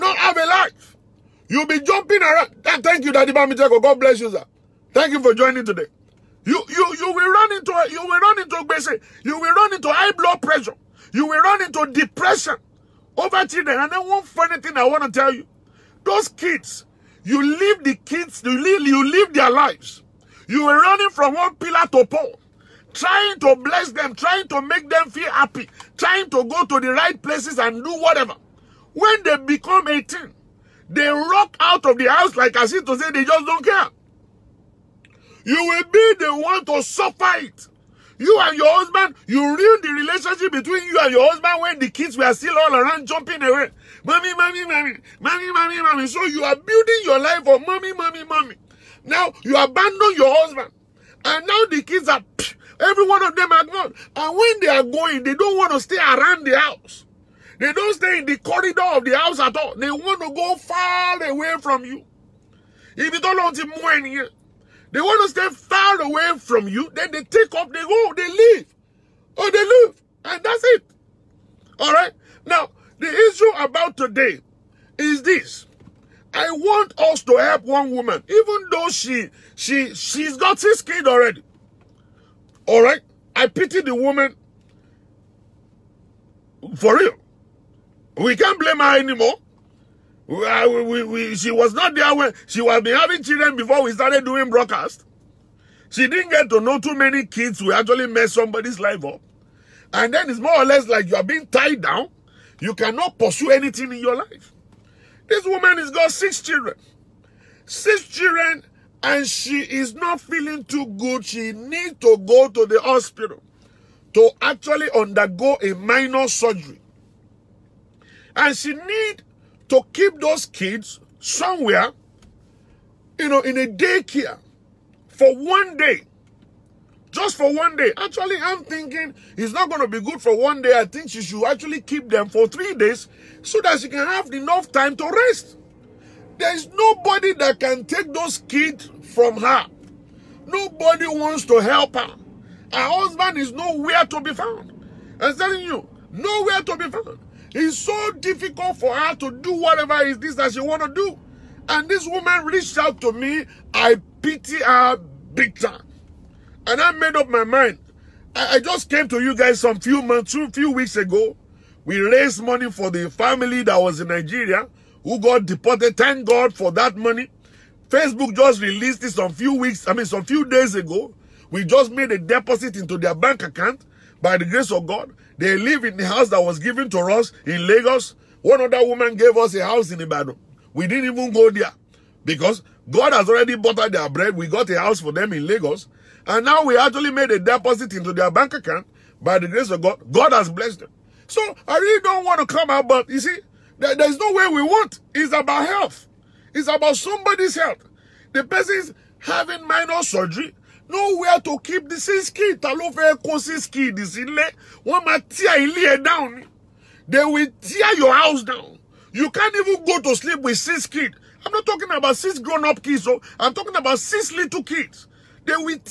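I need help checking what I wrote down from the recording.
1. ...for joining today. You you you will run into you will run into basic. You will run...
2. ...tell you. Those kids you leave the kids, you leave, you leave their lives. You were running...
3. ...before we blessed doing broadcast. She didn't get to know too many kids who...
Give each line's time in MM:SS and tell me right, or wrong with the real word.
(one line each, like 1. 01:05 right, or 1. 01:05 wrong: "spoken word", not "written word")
1. 00:05 right
2. 00:15 right
3. 01:33 wrong: "started", not "blessed".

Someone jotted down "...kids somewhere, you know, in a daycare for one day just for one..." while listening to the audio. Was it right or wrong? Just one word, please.
right.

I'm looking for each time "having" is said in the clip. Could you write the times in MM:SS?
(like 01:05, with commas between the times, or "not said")
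01:32, 03:19.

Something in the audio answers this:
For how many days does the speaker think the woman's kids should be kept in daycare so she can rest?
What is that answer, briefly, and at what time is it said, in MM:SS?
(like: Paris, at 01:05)
3, at 02:12.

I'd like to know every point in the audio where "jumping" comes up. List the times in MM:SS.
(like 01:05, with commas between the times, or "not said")
00:01, 00:43.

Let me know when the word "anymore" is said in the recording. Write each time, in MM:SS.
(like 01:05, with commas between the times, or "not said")
01:28.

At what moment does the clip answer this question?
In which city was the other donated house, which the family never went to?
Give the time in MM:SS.
03:00.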